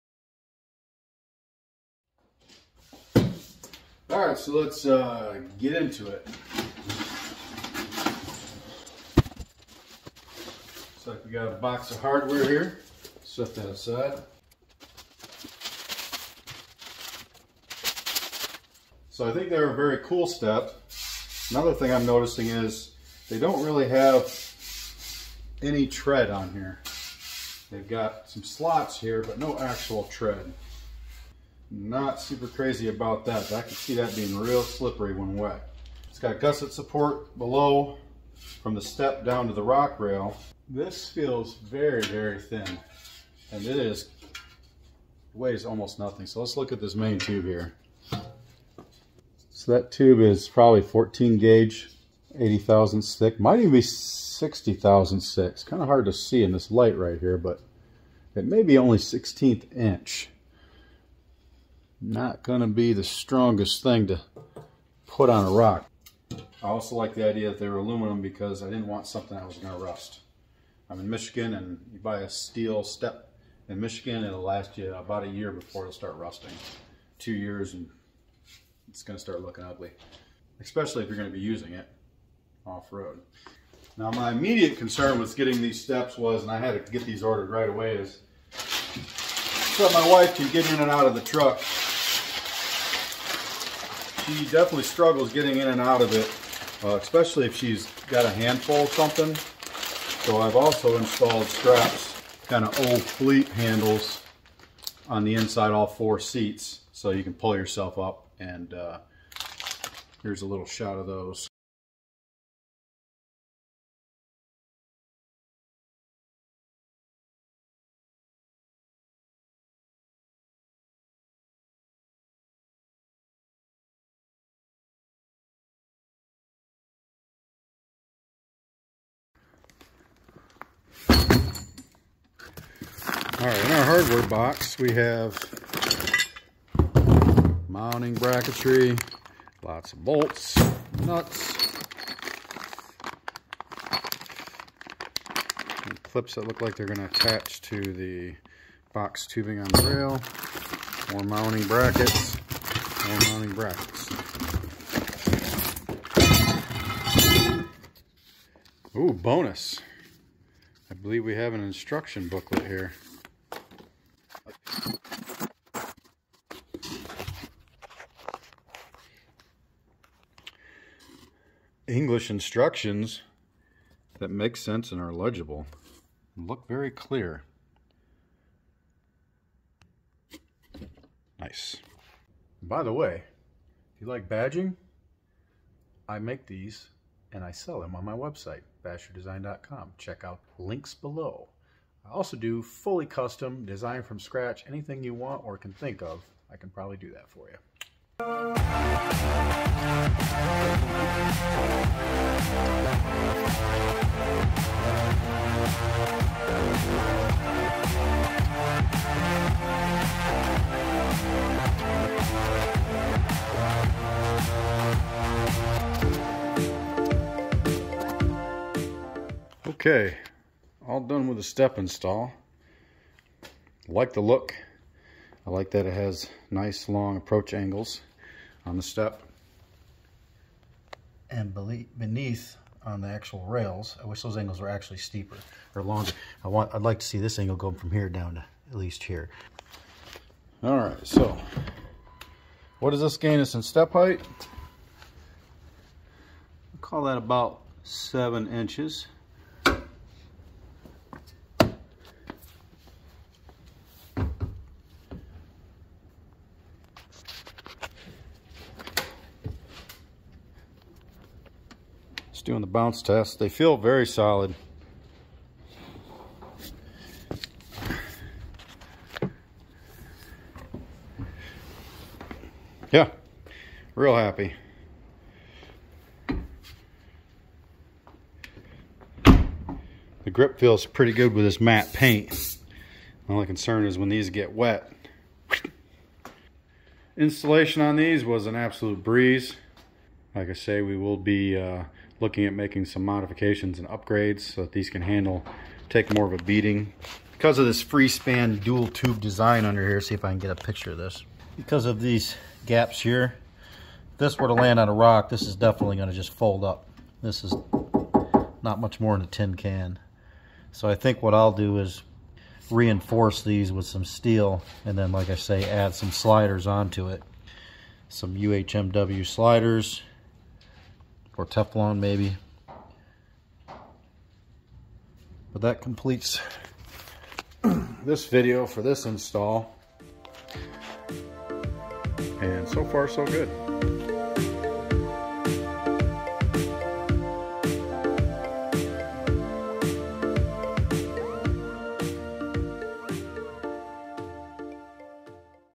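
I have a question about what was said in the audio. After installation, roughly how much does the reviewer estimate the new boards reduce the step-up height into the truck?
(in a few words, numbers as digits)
7 inches.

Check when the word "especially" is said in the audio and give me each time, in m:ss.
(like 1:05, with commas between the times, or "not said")
1:20, 1:36.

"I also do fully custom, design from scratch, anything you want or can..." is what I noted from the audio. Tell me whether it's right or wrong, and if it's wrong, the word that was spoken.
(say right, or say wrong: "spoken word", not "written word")
right.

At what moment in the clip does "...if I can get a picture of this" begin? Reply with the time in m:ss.
5:00.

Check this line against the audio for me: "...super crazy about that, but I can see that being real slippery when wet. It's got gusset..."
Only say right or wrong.
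right.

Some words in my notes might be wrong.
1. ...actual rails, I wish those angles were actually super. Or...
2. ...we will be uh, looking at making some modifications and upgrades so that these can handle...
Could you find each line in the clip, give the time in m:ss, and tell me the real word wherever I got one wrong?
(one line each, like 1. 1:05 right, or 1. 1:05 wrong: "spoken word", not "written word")
1. 3:53 wrong: "steeper", not "super"
2. 4:50 right.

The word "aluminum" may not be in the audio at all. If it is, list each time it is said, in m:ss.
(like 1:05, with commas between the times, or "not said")
1:07.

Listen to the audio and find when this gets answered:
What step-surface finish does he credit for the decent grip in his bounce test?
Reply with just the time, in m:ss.
4:41.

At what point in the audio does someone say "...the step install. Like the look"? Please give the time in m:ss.
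3:41.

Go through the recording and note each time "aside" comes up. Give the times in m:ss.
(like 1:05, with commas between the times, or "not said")
0:13.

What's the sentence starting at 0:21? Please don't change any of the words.
Another thing I'm noticing is they don't really have any tread on here.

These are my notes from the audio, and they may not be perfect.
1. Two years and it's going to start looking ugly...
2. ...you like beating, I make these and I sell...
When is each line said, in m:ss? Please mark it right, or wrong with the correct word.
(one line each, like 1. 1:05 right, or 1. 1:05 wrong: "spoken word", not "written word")
1. 1:17 right
2. 3:03 wrong: "badging", not "beating".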